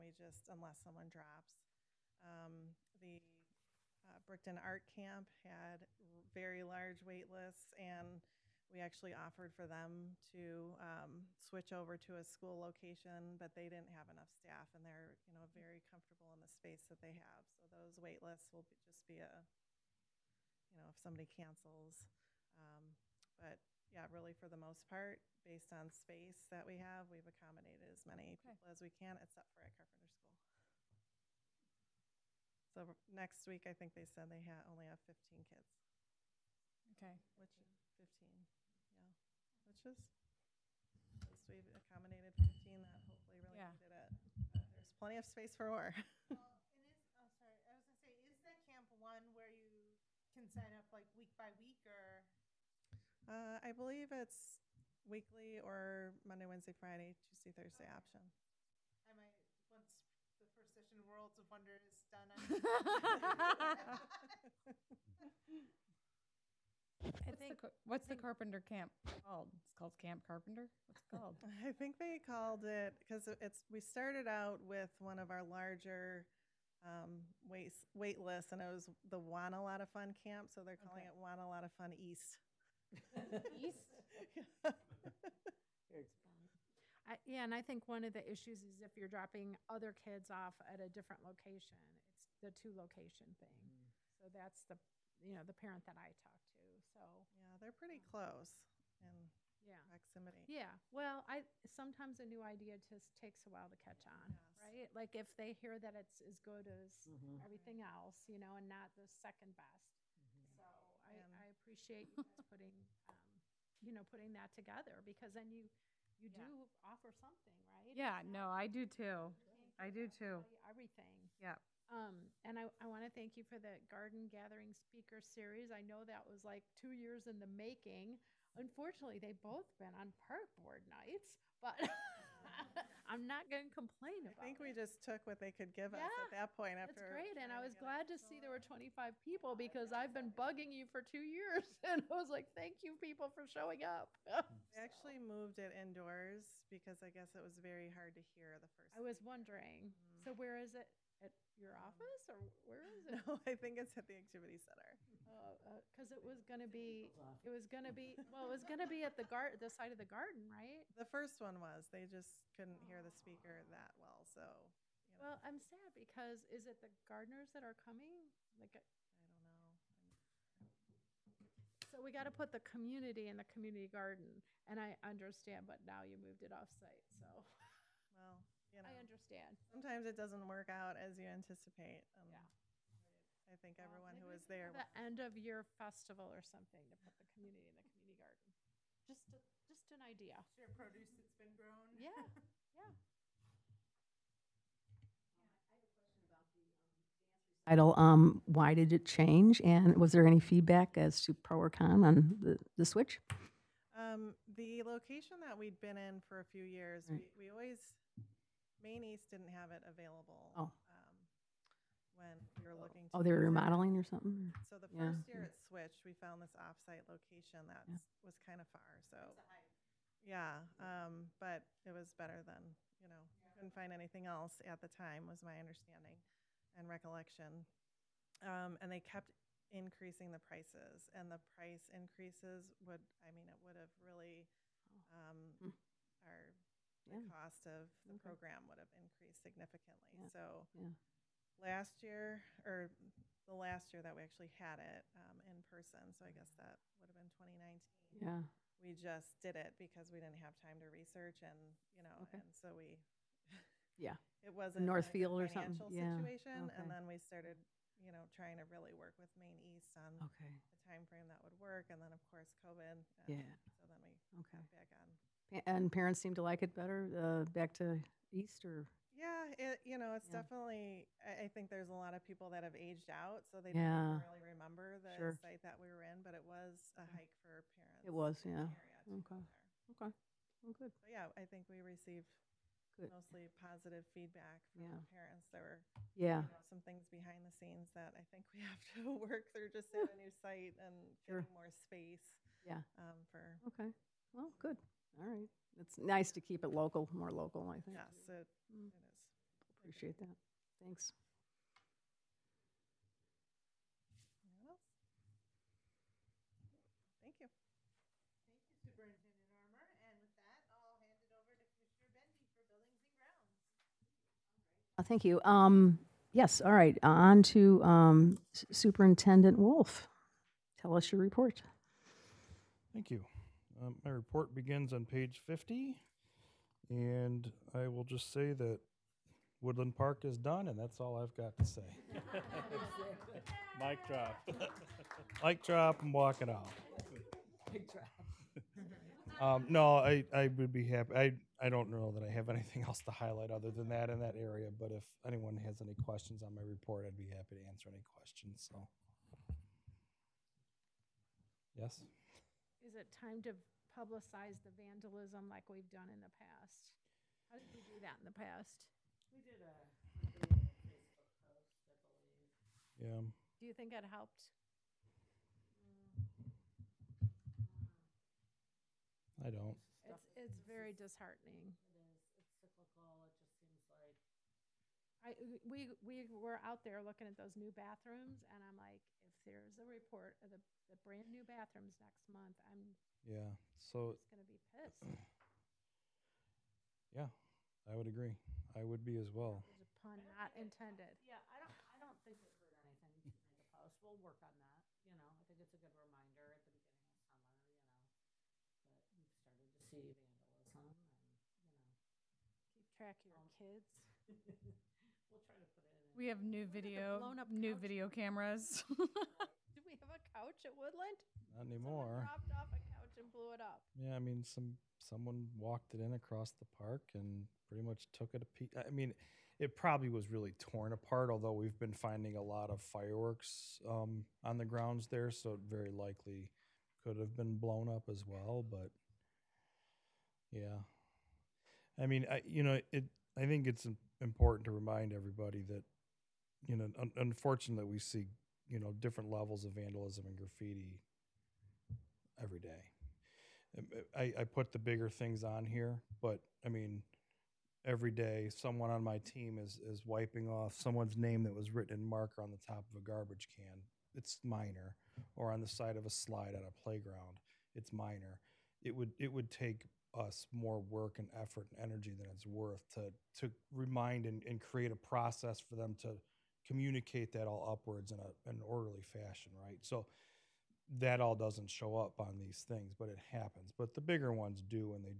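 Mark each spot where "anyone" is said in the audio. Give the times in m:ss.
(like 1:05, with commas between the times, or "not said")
5:04, 5:45.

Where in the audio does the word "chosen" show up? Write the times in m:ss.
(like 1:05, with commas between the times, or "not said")
not said.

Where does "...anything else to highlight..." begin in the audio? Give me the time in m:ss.
5:42.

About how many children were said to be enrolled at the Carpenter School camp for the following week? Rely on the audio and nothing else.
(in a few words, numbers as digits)
15.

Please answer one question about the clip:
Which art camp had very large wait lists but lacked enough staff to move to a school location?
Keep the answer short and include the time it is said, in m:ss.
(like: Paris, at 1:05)
Brickton Art Camp, at 0:04.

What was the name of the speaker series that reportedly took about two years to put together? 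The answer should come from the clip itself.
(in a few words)
Garden Gathering Speaker Series.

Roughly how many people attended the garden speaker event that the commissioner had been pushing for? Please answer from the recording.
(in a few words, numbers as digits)
25.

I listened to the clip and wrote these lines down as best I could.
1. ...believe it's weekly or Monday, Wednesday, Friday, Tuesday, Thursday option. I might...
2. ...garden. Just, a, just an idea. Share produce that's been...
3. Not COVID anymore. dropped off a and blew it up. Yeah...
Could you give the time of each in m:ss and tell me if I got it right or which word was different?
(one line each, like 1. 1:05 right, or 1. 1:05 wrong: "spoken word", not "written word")
1. 0:53 right
2. 3:08 right
3. 6:51 wrong: "Someone", not "COVID".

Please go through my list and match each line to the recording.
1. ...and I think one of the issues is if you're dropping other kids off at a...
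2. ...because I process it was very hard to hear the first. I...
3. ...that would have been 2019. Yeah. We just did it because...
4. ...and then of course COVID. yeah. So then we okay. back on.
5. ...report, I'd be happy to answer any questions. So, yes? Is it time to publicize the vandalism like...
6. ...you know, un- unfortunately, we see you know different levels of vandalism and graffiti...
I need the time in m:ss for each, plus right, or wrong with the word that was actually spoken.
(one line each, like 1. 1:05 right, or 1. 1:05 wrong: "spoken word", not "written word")
1. 1:27 right
2. 2:26 wrong: "guess", not "process"
3. 4:06 right
4. 4:21 right
5. 5:46 right
6. 7:16 right.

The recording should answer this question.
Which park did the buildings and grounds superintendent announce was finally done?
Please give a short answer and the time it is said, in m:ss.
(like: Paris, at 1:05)
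Woodland Park, at 5:29.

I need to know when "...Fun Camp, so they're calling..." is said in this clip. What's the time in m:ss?
1:19.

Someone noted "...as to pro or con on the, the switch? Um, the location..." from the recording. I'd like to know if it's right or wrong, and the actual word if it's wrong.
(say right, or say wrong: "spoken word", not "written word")
right.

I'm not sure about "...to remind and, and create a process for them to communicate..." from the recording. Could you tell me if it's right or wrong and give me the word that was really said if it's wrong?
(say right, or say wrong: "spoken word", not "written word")
right.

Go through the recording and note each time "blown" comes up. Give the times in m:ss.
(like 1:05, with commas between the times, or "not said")
6:47, 7:07.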